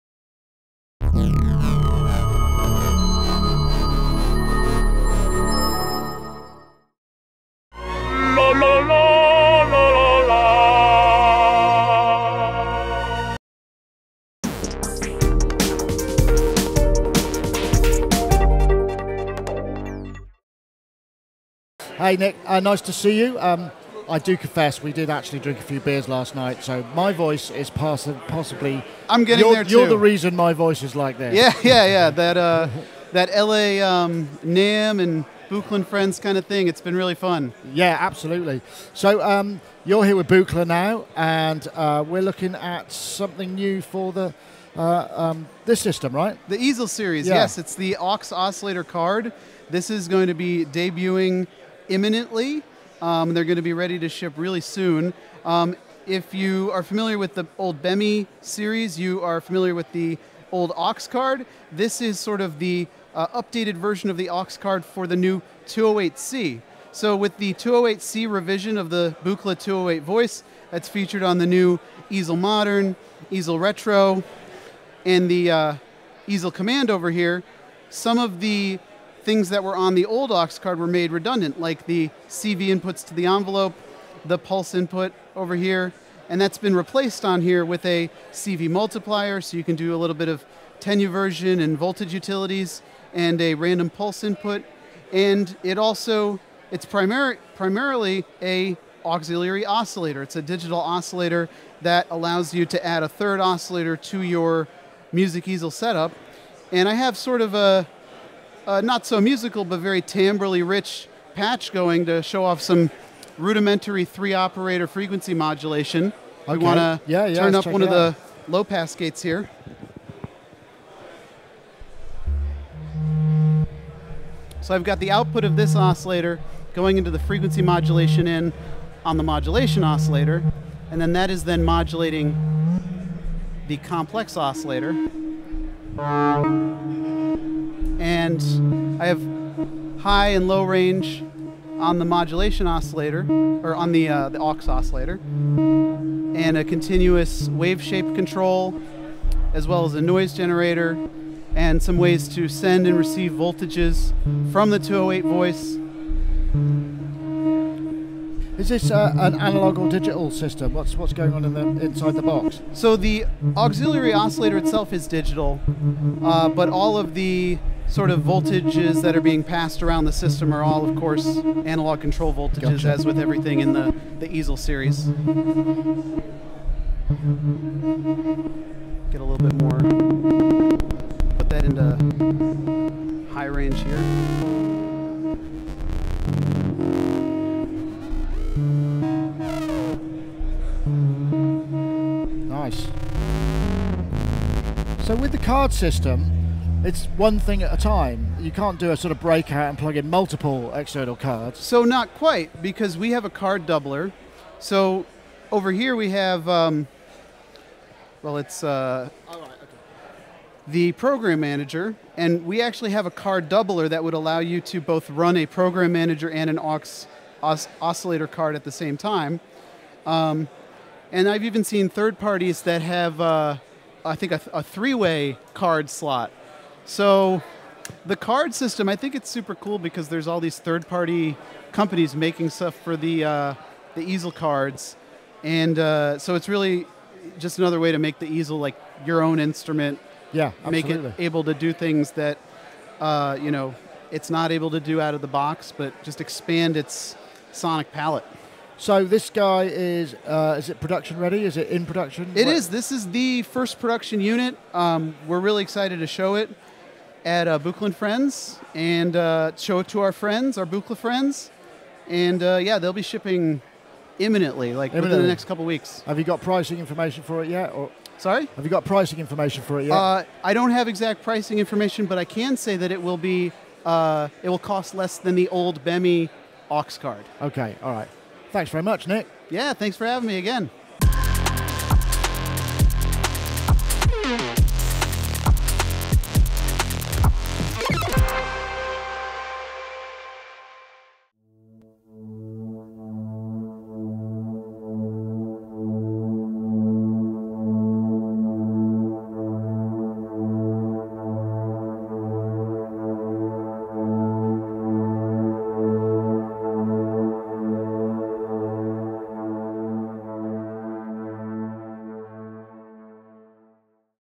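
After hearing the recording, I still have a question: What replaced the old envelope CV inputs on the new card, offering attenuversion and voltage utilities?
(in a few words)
CV multiplier.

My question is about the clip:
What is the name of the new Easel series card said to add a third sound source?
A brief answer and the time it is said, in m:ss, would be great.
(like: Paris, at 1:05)
Aux oscillator card, at 0:47.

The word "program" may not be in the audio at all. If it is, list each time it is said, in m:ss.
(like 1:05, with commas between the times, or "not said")
3:30, 3:35.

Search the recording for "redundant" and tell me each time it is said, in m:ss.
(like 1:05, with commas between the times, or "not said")
1:21.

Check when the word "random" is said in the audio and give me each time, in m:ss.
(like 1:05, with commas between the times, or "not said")
1:33.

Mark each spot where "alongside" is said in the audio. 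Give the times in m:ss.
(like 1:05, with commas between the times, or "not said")
not said.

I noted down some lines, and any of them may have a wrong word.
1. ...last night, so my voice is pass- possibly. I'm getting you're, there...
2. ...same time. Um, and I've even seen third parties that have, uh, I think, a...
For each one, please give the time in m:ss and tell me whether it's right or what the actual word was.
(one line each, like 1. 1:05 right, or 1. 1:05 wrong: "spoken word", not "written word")
1. 0:26 right
2. 3:38 right.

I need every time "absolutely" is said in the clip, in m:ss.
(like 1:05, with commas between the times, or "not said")
0:37, 4:00.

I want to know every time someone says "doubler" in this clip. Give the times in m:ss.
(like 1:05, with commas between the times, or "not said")
3:23, 3:33.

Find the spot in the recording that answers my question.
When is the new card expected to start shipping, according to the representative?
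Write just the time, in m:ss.
4:25.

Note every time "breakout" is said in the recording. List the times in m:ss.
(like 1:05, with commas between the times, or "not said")
3:19.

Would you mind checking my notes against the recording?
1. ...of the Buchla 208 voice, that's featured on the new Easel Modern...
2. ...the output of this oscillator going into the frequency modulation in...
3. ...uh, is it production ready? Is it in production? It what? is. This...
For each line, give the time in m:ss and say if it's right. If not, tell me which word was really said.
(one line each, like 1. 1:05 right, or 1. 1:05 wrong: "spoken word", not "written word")
1. 1:08 right
2. 2:04 right
3. 4:10 right.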